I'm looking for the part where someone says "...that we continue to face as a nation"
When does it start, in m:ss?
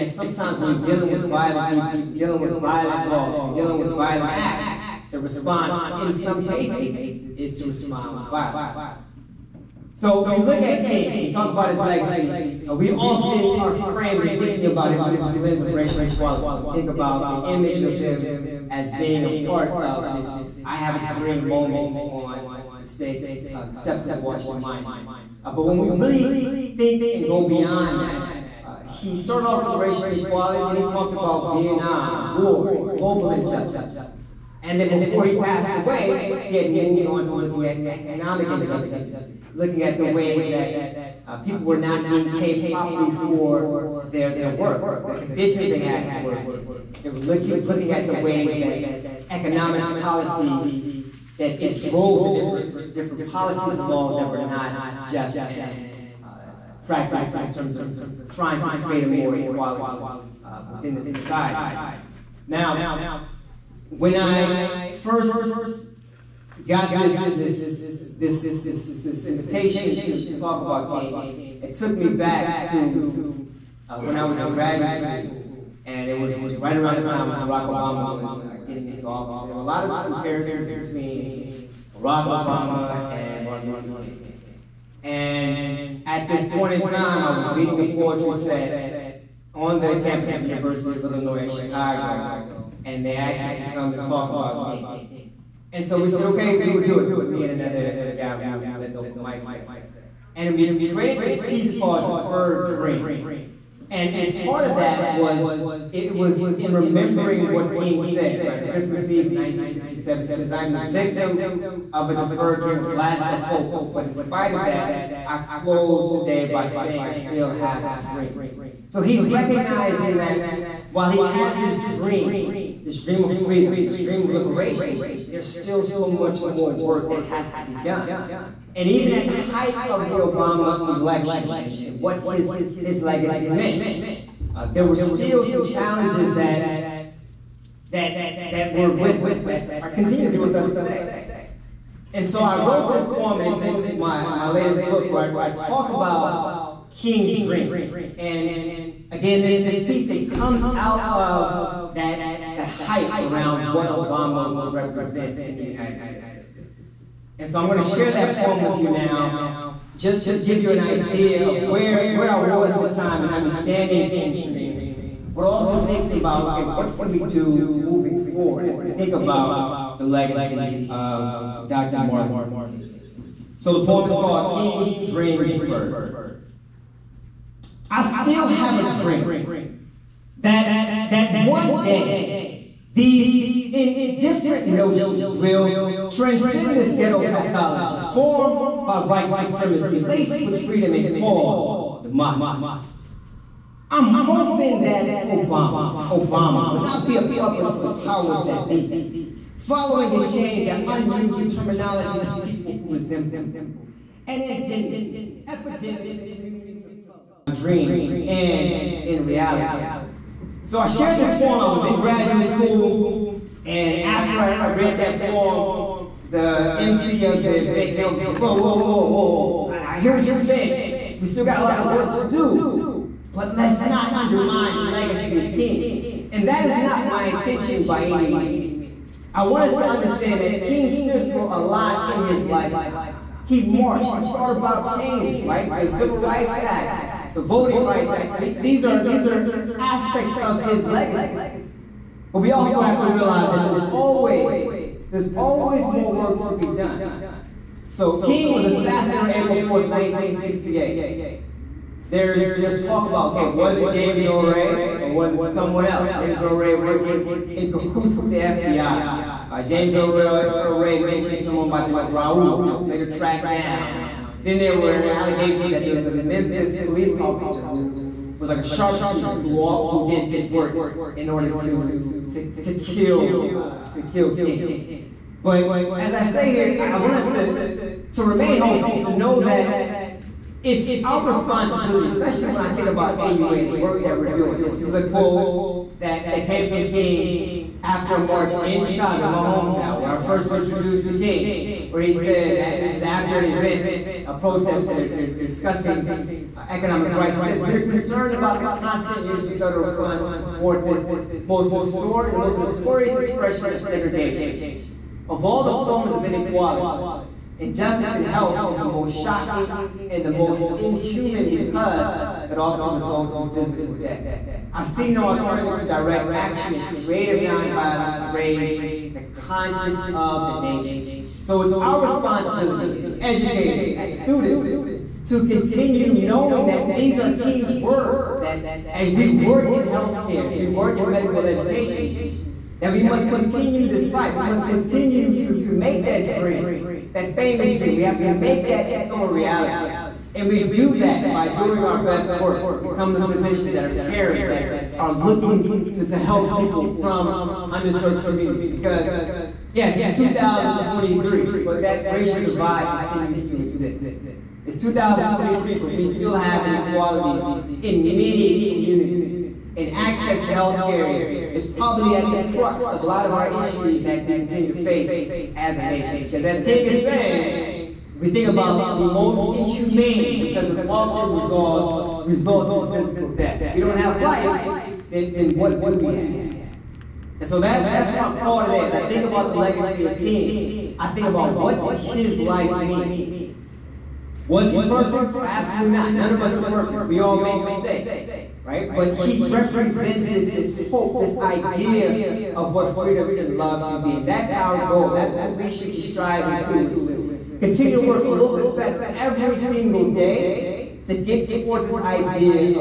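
6:04.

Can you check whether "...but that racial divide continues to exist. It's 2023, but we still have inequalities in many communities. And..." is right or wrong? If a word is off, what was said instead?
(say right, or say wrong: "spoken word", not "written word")
right.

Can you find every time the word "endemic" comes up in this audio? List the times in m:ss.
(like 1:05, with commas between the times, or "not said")
3:24.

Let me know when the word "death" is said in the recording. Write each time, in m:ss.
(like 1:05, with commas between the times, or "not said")
5:13, 6:13.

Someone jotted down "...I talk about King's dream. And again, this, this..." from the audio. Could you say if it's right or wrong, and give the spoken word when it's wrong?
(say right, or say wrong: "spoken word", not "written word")
right.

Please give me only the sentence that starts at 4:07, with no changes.
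So King was assassinated on April 4th, 1968.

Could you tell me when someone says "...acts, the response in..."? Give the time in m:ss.
0:04.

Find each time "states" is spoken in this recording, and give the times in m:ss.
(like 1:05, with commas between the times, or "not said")
0:22, 2:35.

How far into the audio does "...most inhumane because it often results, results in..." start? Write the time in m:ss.
6:09.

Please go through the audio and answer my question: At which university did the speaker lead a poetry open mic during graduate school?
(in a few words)
University of Illinois at Chicago.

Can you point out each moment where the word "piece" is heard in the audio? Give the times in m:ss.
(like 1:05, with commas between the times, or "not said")
1:41, 2:29.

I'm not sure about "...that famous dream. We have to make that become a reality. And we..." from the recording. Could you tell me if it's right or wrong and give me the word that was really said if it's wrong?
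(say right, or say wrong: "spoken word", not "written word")
right.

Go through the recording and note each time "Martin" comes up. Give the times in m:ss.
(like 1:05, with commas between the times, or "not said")
1:23, 2:51.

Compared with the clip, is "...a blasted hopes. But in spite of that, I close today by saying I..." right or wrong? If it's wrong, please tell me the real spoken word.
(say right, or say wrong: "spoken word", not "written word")
right.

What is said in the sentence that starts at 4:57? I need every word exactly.
we're concerned about the constant use of federal funds to support this most, the most notorious expression of segregation.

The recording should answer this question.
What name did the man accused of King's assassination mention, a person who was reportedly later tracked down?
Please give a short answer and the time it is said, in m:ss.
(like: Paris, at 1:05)
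Raul, at 4:22.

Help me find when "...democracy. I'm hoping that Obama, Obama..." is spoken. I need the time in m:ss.
3:12.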